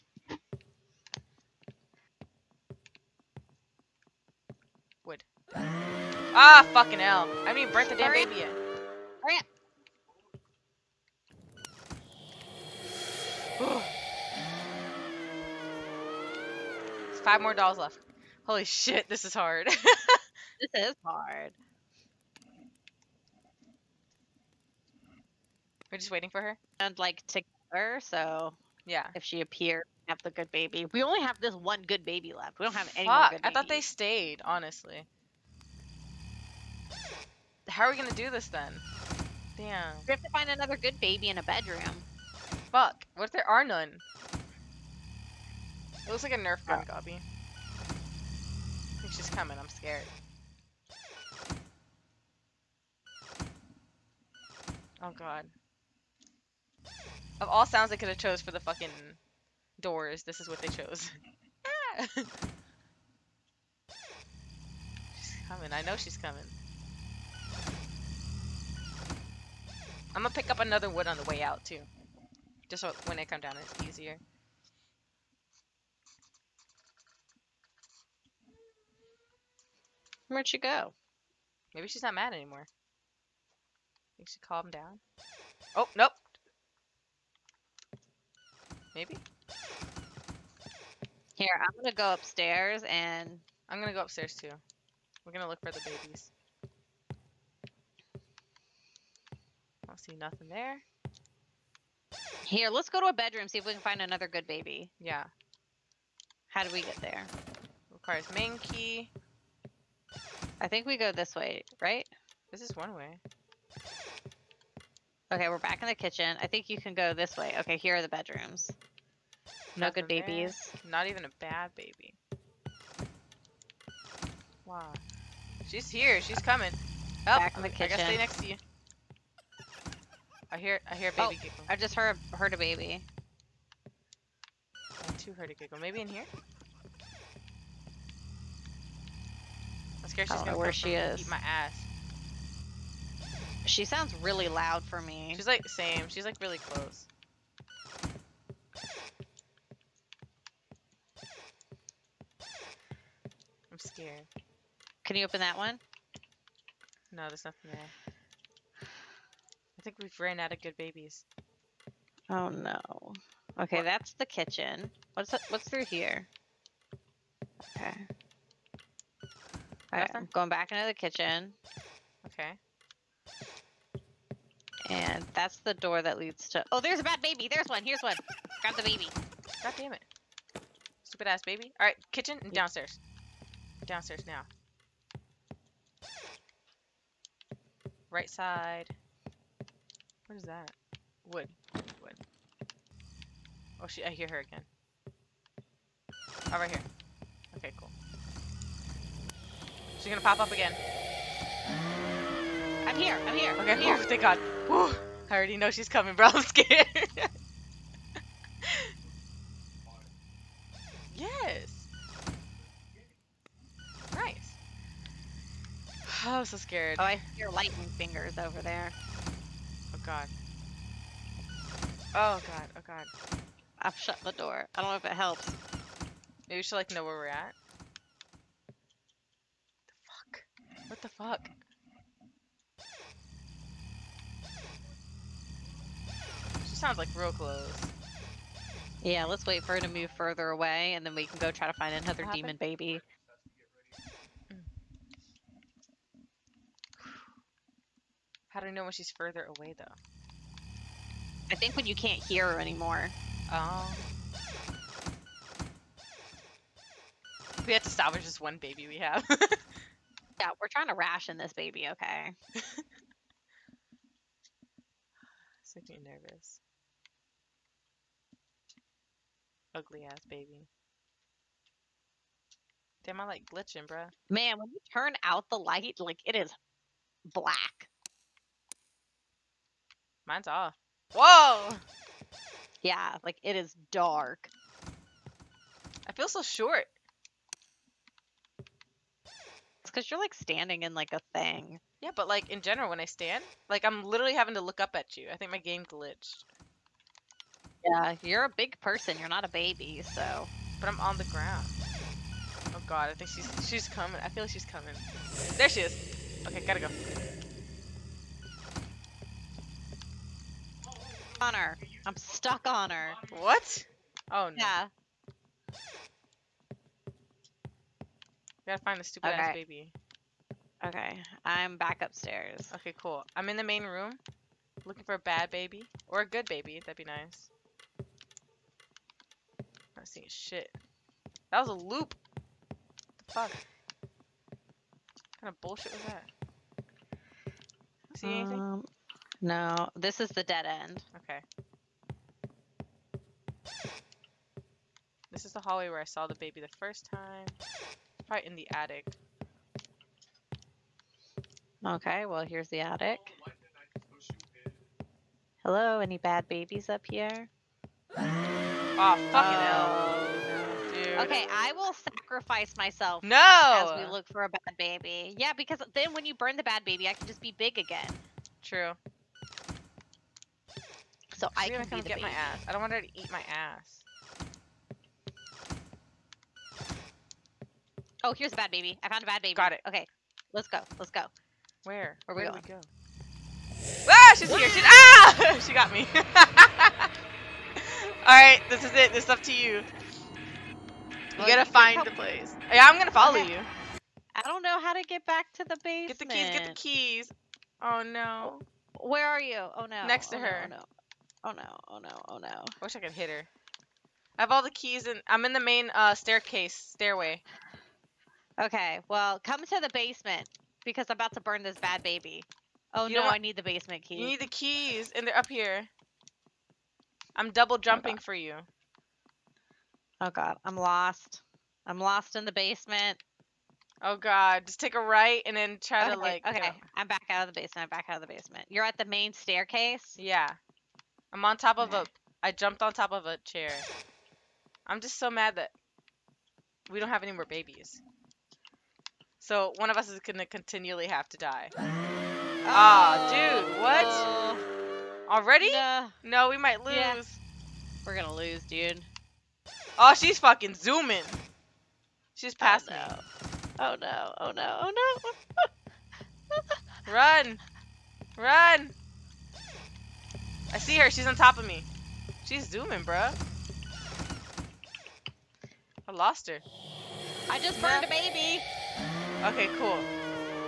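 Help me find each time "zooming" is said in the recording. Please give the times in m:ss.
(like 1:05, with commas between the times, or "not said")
7:30, 7:42.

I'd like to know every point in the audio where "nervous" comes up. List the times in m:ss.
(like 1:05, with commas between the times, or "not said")
4:26.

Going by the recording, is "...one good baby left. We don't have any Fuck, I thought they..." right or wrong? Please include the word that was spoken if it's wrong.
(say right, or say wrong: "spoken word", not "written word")
right.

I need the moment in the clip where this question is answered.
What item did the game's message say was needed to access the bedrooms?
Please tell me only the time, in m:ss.
1:48.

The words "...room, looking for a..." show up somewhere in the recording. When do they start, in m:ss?
5:23.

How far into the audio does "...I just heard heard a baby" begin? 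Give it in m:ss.
2:11.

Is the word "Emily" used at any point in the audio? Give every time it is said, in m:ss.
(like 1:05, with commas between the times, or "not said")
not said.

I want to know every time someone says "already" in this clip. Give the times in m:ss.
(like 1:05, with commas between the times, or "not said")
3:25, 7:25.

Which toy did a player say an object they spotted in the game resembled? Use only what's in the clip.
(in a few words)
Nerf gun.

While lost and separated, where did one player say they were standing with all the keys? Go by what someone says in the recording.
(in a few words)
Main staircase.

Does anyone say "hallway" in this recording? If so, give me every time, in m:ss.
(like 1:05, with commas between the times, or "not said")
5:45.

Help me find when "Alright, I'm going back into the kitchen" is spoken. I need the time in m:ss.
2:49.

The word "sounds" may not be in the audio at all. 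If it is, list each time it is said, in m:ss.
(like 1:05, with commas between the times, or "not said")
0:57, 2:23, 3:56.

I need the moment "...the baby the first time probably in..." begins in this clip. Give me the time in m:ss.
5:46.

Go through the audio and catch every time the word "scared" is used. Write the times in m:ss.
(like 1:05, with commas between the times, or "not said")
0:49, 2:20, 2:33, 3:26, 3:36.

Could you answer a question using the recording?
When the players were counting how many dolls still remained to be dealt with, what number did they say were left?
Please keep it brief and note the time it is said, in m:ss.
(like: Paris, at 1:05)
5, at 0:17.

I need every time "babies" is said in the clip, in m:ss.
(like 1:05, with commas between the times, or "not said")
1:35, 2:00, 2:40, 5:56, 7:17.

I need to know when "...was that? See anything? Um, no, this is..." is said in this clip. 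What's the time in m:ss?
5:35.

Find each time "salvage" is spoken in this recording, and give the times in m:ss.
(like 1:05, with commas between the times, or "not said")
4:17.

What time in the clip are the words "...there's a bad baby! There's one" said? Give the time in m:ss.
2:56.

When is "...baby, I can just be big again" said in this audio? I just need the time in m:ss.
6:06.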